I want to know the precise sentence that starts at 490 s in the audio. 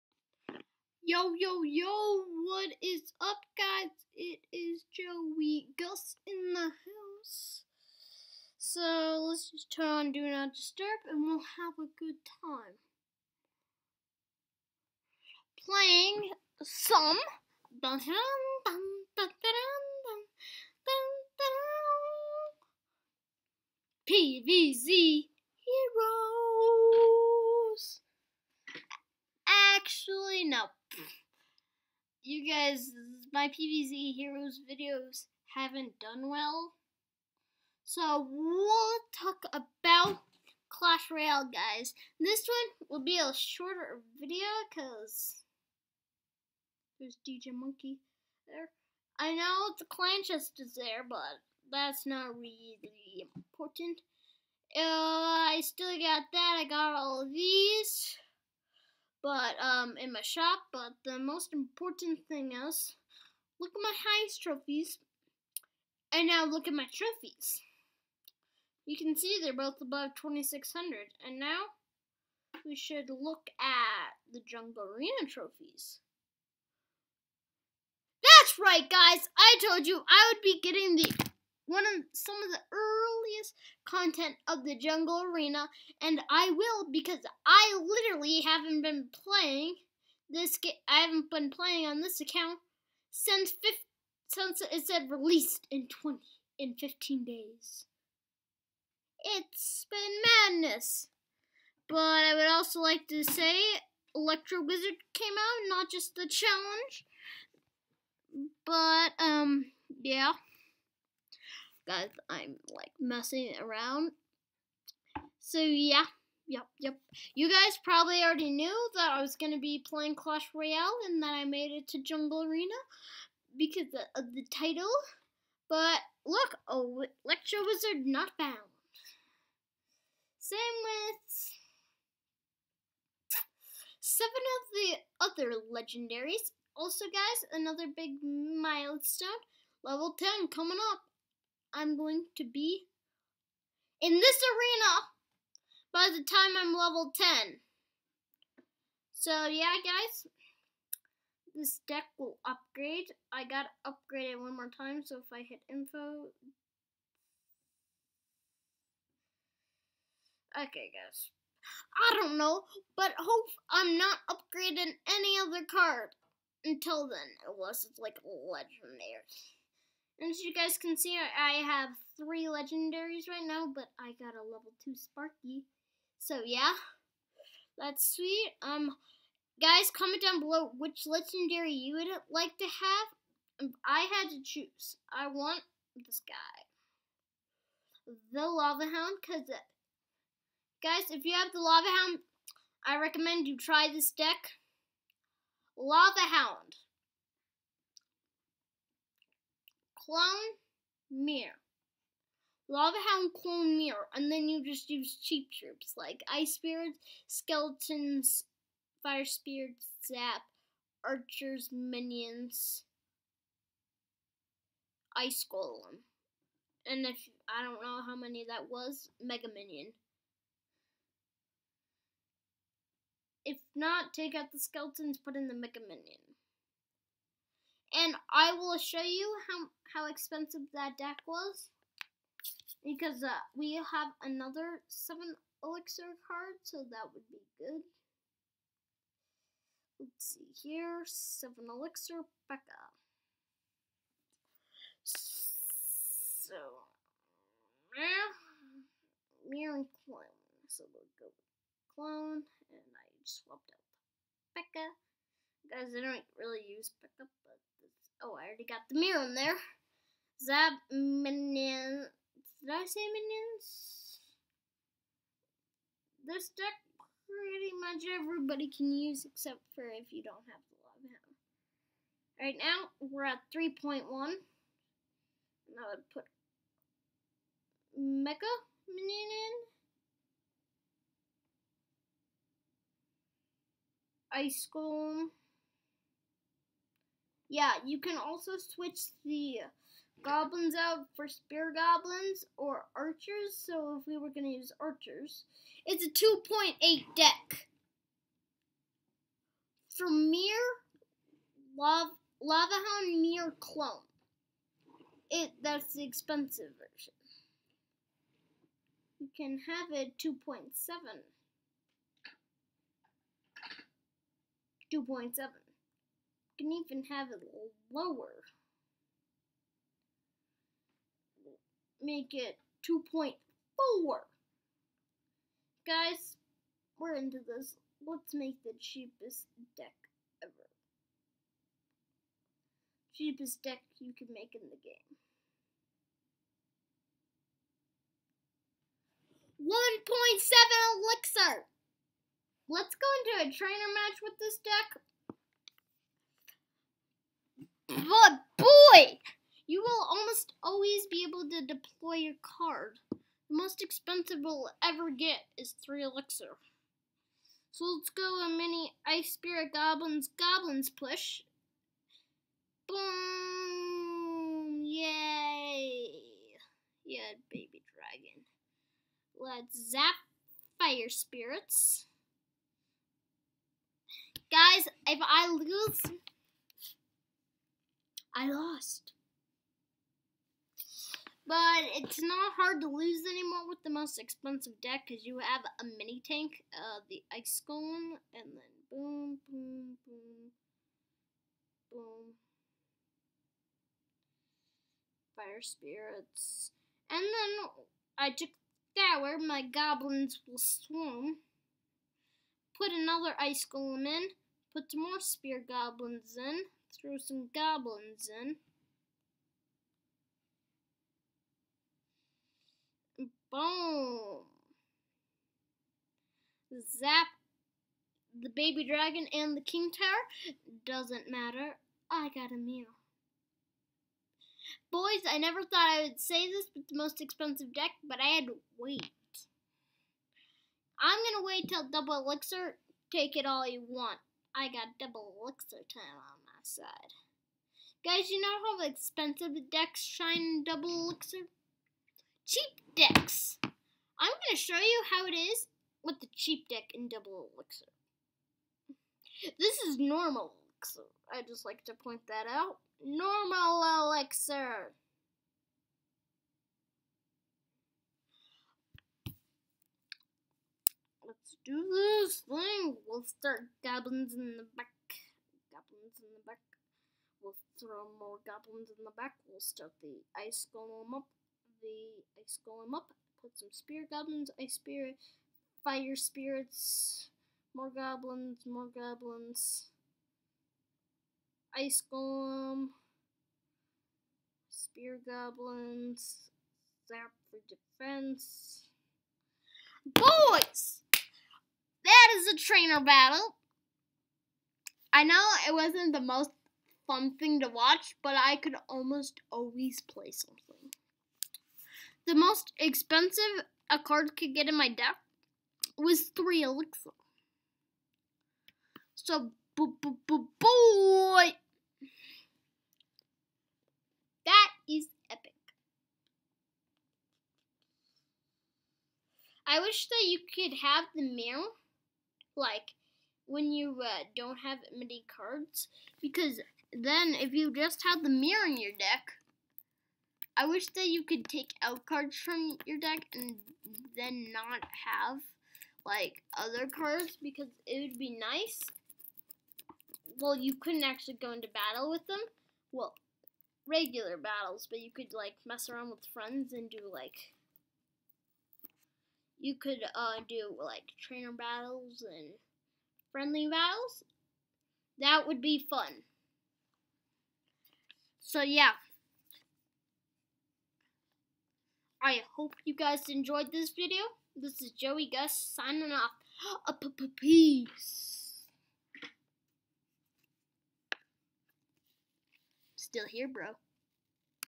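Boys, that is a trainer battle.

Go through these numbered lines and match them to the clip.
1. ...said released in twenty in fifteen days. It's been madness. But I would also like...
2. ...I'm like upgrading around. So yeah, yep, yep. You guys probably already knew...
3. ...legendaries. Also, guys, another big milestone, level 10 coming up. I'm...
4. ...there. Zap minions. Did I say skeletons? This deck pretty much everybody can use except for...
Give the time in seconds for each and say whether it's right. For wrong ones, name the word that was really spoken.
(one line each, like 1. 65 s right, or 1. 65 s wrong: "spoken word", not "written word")
1. 94 s right
2. 112 s wrong: "messing", not "upgrading"
3. 135 s right
4. 259 s wrong: "minions", not "skeletons".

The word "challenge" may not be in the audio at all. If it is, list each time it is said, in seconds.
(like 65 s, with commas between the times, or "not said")
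106 s.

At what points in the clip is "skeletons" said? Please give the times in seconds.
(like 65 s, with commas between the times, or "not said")
207 s, 224 s.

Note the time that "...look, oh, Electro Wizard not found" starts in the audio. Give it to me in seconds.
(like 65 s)
126 s.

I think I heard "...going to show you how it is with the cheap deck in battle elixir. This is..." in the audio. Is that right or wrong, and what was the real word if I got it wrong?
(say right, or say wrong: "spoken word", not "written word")
wrong: "double", not "battle".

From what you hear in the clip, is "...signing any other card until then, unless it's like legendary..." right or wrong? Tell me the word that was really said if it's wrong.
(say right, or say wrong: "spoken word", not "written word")
wrong: "upgrading", not "signing".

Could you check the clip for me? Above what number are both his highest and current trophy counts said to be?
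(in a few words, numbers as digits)
2600.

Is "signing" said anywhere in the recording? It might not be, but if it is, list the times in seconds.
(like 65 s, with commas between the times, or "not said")
565 s.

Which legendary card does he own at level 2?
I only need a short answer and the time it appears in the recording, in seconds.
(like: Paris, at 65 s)
Sparky, at 174 s.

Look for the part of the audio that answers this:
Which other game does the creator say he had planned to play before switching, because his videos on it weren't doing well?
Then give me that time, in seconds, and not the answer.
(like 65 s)
33 s.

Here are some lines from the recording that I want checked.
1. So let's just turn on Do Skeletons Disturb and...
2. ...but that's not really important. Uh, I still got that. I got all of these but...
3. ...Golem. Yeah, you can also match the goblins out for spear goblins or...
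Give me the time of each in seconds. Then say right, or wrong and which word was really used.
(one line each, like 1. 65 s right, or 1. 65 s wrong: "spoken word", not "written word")
1. 8 s wrong: "Not", not "Skeletons"
2. 51 s right
3. 284 s wrong: "switch", not "match".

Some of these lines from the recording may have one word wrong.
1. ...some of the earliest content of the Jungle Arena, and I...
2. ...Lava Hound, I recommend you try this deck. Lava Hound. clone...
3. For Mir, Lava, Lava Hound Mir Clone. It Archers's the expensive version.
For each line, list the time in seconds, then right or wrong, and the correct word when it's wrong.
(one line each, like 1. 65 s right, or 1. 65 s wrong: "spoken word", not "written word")
1. 82 s right
2. 191 s right
3. 299 s wrong: "That", not "Archers".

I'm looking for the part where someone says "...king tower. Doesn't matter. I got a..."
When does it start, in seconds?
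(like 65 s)
419 s.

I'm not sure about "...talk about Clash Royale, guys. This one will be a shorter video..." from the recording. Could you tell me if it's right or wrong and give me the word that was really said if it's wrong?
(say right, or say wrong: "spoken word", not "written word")
right.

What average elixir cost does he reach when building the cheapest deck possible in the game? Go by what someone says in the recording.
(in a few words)
1.7.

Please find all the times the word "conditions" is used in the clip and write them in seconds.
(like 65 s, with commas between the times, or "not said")
not said.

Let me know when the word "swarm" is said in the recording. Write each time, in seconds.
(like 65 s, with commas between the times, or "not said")
400 s.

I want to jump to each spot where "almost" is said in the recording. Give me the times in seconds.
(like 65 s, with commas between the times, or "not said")
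350 s, 498 s.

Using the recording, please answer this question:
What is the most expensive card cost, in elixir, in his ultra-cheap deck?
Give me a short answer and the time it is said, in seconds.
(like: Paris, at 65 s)
3, at 355 s.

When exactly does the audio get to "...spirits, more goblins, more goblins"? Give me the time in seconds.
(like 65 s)
476 s.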